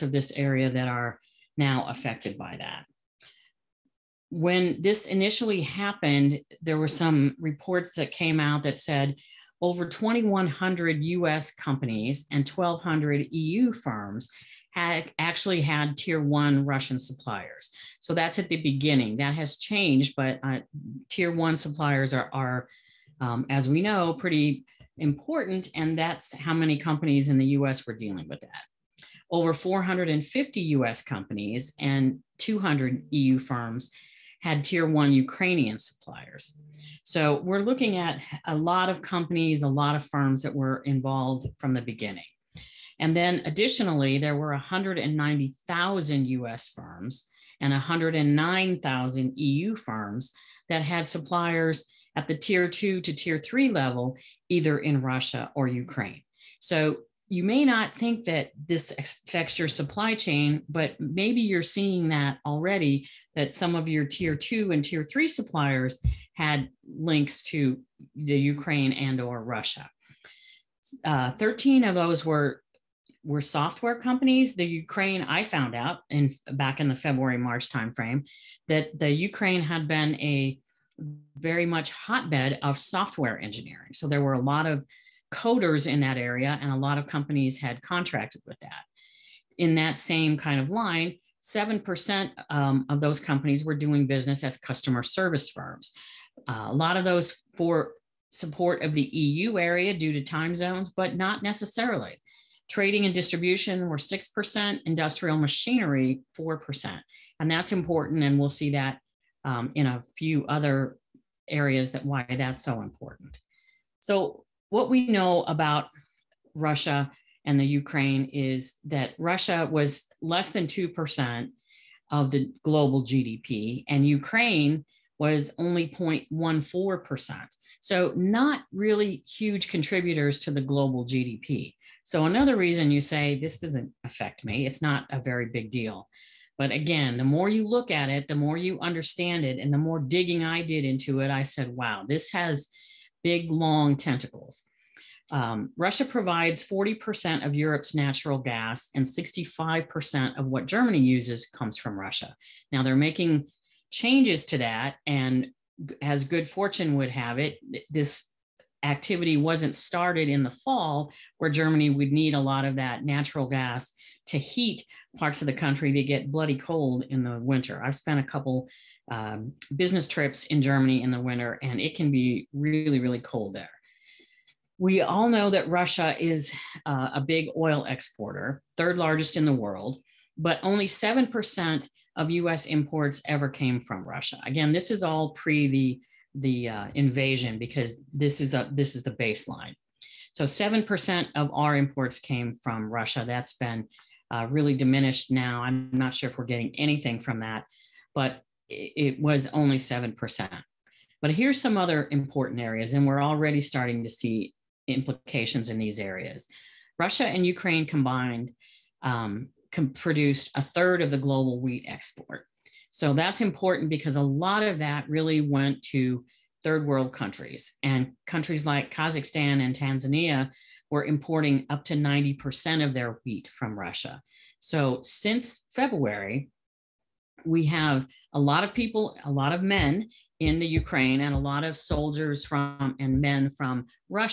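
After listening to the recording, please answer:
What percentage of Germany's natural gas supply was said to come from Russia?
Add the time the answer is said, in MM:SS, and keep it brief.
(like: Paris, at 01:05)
65%, at 02:29.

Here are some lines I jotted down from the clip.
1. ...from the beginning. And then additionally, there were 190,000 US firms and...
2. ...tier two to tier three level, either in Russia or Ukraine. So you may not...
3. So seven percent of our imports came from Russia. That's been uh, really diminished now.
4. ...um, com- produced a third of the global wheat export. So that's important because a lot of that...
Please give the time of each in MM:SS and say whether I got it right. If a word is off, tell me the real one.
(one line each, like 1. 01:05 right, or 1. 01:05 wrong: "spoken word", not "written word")
1. 00:41 right
2. 00:52 right
3. 03:10 right
4. 03:29 right.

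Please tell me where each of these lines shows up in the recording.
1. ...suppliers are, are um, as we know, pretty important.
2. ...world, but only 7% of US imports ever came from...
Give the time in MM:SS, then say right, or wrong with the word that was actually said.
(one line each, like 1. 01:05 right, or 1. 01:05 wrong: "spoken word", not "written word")
1. 00:21 right
2. 02:59 right.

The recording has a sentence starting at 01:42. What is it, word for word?
Trading and distribution were 6%, industrial machinery 4%.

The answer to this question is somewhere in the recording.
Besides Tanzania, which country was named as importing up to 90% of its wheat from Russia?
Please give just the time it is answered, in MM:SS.
03:38.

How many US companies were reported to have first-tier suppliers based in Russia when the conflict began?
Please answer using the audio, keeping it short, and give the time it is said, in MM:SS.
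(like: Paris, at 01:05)
2,100, at 00:09.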